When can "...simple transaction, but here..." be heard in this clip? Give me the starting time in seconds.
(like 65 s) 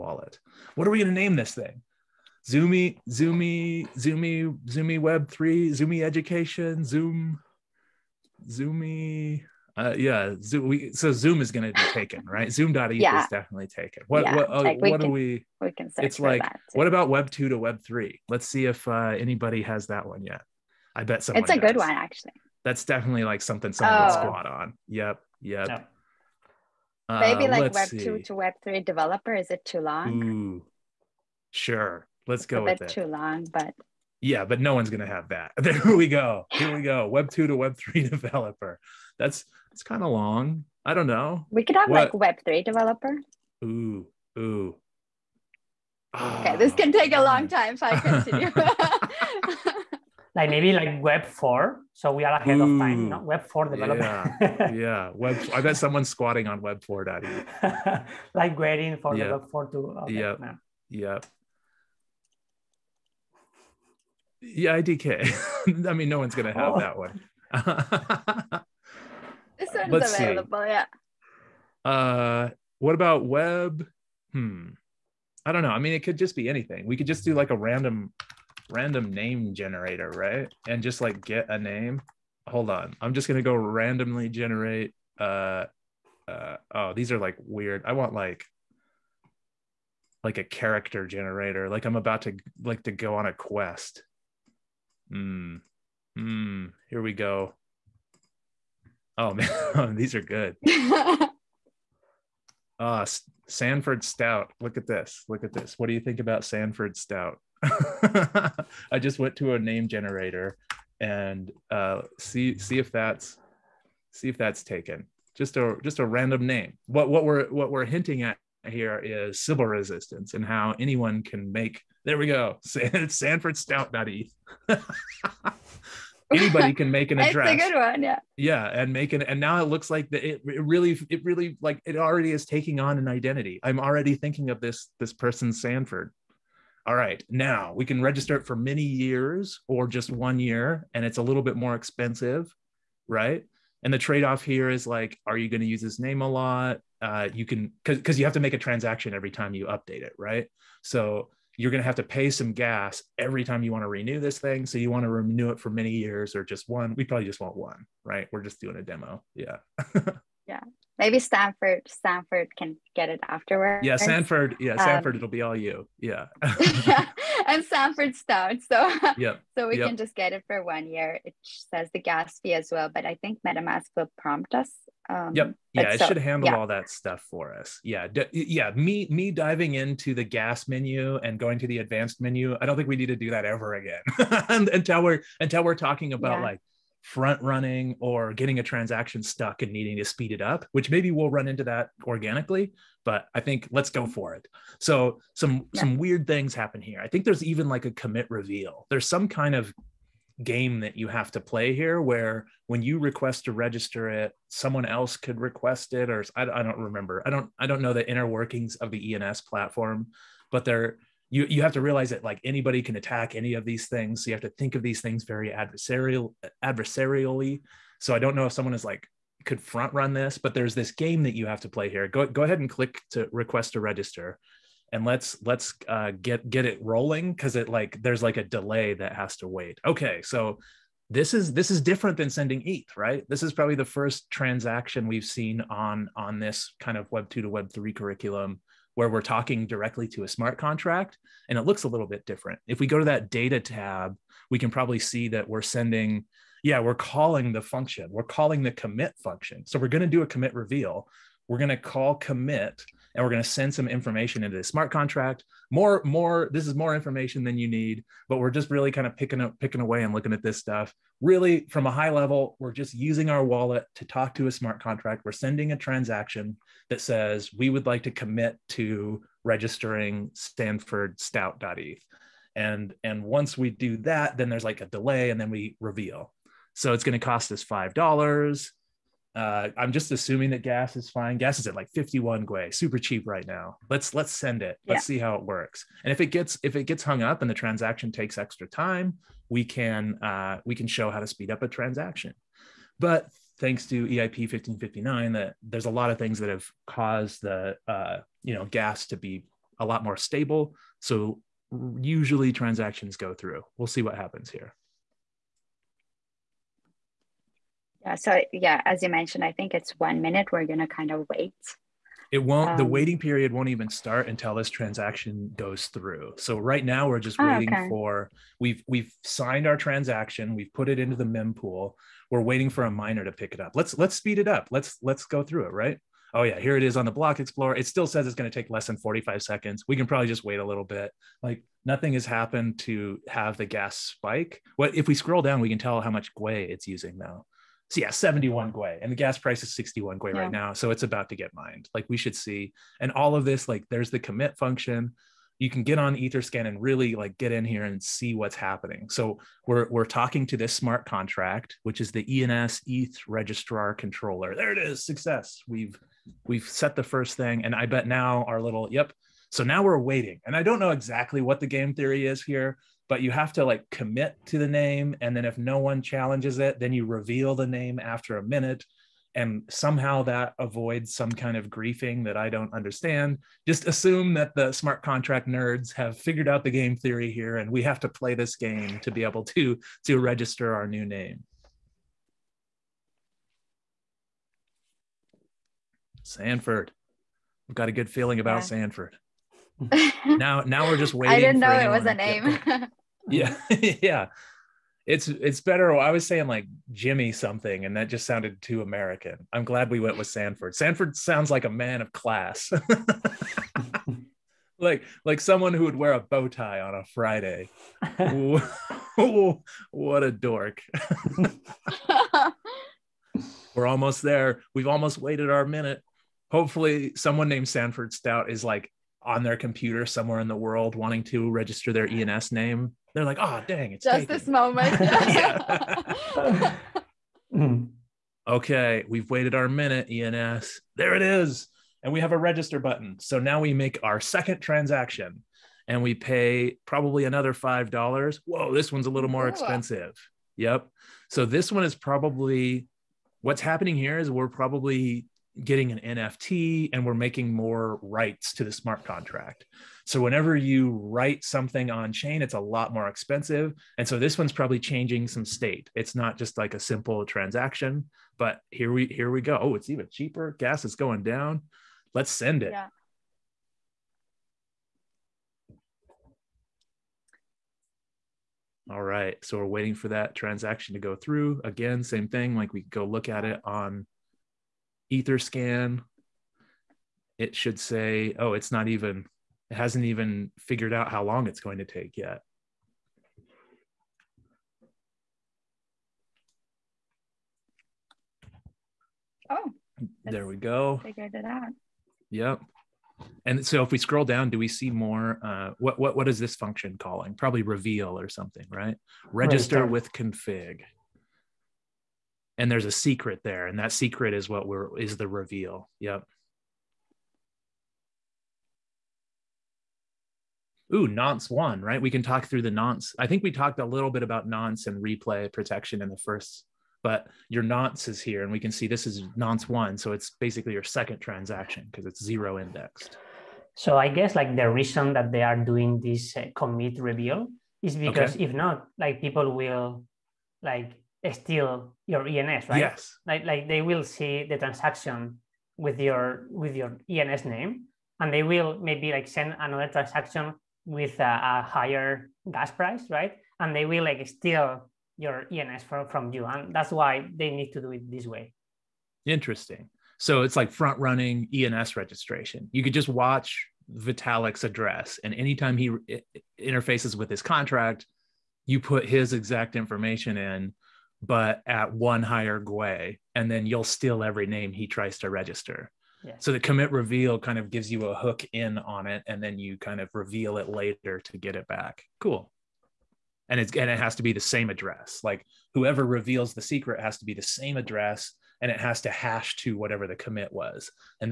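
456 s.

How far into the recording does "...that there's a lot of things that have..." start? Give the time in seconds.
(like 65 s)
295 s.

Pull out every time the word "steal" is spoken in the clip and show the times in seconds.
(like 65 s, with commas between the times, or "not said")
531 s, 544 s, 563 s.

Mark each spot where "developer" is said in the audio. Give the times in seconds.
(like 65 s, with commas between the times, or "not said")
28 s, 38 s, 42 s, 53 s.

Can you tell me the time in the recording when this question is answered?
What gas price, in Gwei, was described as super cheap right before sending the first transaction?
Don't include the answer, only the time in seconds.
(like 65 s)
281 s.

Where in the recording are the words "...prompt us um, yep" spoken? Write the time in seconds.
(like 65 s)
174 s.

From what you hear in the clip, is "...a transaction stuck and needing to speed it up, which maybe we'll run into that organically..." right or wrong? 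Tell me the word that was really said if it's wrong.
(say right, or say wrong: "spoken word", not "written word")
right.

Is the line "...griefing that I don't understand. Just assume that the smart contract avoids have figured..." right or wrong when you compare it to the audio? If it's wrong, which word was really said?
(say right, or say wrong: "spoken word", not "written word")
wrong: "nerds", not "avoids".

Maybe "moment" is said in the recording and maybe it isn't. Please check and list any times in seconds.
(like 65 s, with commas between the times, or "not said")
424 s.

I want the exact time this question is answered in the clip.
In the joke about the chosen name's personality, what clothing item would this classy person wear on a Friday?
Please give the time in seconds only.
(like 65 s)
406 s.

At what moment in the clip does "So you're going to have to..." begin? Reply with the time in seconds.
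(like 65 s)
150 s.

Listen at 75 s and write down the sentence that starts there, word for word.
I mean, it could just be anything.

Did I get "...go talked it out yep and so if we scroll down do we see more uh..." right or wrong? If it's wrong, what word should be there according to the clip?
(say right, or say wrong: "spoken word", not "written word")
wrong: "figured", not "talked".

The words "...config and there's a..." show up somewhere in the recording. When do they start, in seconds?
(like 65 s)
500 s.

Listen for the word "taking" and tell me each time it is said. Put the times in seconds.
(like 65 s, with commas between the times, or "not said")
132 s.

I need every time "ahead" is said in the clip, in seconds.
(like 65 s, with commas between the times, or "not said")
52 s, 222 s.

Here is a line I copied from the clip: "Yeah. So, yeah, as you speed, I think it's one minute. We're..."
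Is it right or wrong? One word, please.
wrong.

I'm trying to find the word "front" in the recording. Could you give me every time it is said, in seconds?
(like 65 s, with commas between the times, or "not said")
187 s, 219 s, 550 s.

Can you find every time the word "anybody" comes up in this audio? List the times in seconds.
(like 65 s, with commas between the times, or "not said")
19 s, 126 s, 212 s.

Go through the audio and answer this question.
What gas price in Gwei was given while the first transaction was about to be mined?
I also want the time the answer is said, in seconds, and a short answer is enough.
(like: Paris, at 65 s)
61 Gwei, at 339 s.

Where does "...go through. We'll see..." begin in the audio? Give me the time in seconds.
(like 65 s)
303 s.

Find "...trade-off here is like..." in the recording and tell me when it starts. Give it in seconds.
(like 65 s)
143 s.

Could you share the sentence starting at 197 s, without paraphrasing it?
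I think there's even like a commit reveal.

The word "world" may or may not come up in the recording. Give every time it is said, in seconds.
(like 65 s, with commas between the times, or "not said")
420 s.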